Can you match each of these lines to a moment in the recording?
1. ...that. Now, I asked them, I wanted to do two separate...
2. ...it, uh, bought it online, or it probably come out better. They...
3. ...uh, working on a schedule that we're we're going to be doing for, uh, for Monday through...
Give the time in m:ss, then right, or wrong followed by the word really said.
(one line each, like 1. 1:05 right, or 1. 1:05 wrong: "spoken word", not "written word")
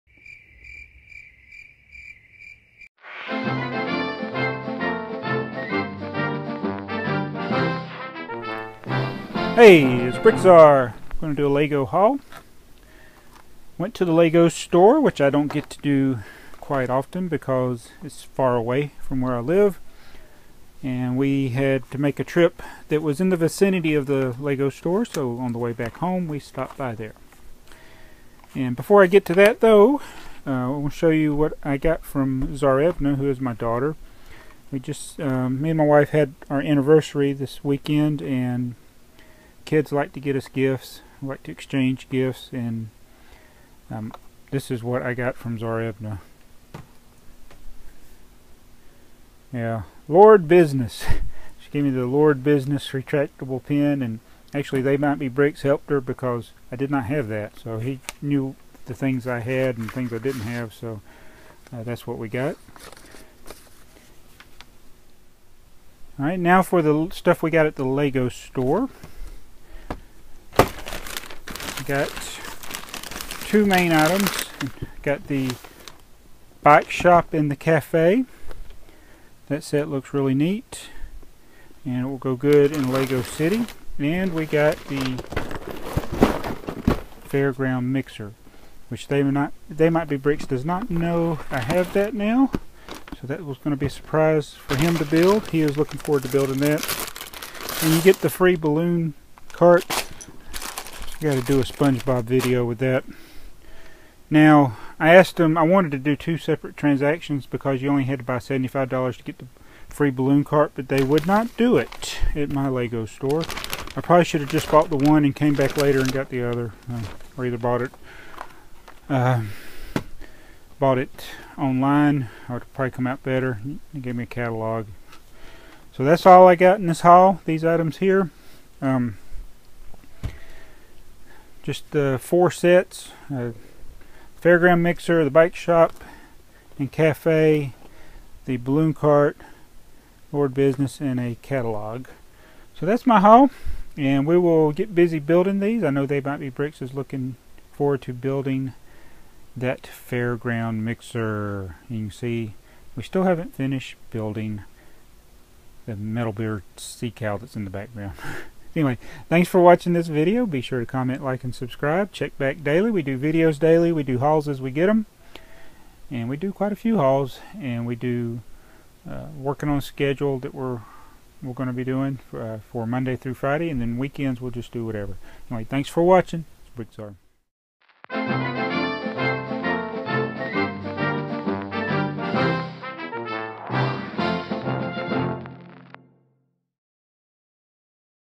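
1. 1:42 right
2. 1:57 right
3. 2:49 right.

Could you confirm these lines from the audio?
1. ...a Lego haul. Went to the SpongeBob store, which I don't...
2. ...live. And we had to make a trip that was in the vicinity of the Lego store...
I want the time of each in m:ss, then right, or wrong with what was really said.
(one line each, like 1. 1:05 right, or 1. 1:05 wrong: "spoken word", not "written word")
1. 0:11 wrong: "Lego", not "SpongeBob"
2. 0:19 right.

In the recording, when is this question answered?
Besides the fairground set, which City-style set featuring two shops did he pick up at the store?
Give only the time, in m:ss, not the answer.
1:16.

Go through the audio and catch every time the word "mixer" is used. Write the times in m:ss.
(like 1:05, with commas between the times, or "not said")
1:27, 2:14, 2:30.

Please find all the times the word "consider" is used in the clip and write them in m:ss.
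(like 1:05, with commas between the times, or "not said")
not said.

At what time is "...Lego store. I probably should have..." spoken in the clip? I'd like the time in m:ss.
1:52.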